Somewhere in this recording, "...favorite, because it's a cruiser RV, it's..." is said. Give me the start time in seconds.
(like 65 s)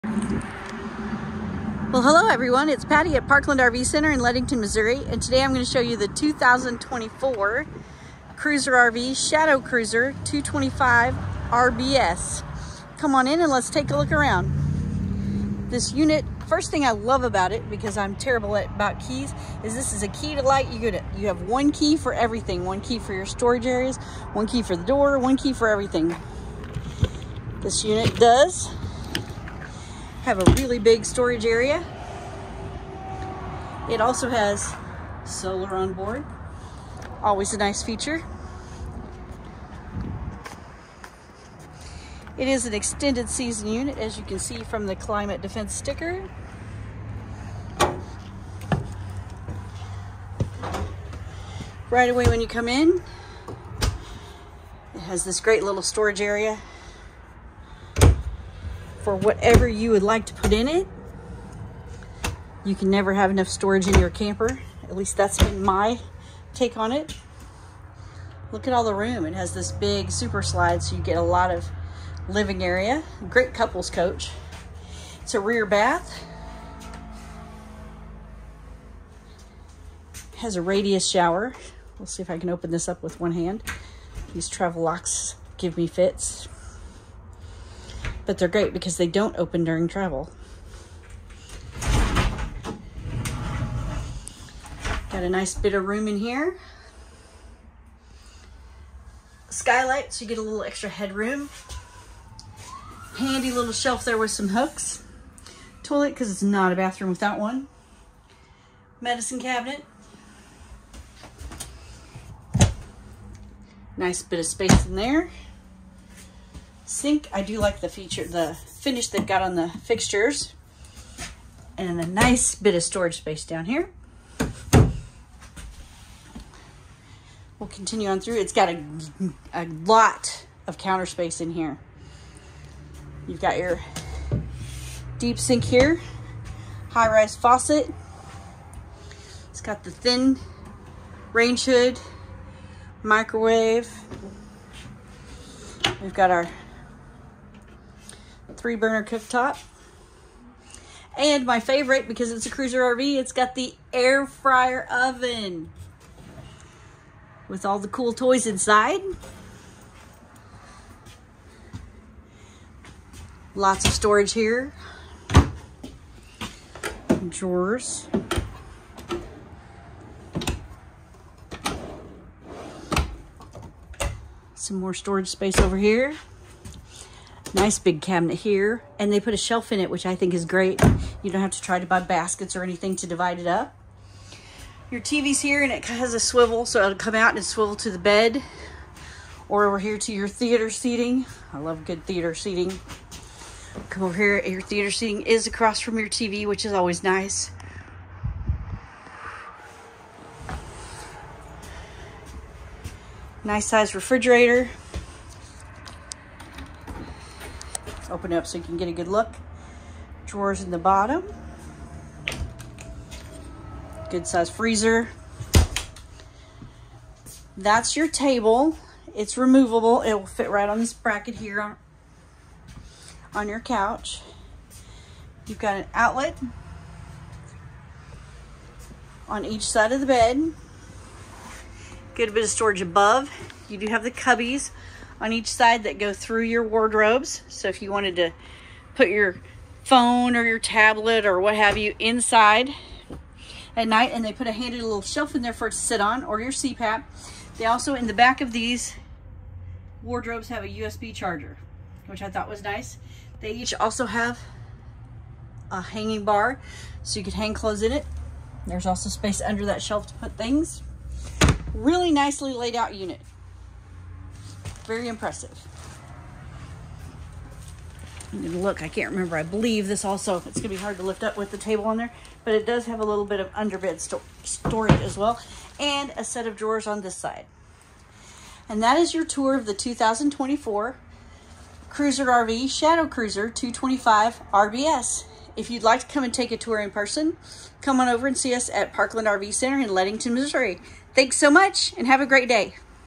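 151 s.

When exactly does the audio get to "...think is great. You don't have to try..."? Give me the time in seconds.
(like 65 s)
180 s.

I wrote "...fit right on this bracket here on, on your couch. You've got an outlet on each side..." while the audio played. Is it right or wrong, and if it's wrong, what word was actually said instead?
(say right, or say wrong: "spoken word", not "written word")
right.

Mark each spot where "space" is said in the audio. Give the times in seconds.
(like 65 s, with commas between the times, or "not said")
114 s, 123 s, 131 s, 175 s, 259 s.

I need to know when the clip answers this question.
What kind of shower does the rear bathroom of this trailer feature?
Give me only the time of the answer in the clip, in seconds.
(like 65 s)
80 s.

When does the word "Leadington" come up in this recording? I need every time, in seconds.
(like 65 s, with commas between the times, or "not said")
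4 s, 289 s.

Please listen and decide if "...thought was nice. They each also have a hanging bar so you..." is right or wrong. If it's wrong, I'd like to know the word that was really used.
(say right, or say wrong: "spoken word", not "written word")
right.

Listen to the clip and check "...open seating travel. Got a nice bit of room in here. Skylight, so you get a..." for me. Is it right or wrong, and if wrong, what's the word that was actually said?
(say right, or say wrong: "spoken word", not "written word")
wrong: "during", not "seating".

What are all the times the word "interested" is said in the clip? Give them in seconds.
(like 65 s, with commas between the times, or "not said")
not said.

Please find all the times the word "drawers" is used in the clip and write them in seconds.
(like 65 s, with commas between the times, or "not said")
167 s, 210 s, 276 s.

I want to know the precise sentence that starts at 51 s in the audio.
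Right away when you come in, it has this great little storage area for whatever you would like to put in it.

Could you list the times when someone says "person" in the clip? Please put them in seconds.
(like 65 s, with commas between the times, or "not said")
286 s.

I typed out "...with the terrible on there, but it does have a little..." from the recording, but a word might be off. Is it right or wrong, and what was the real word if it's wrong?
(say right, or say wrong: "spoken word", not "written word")
wrong: "table", not "terrible".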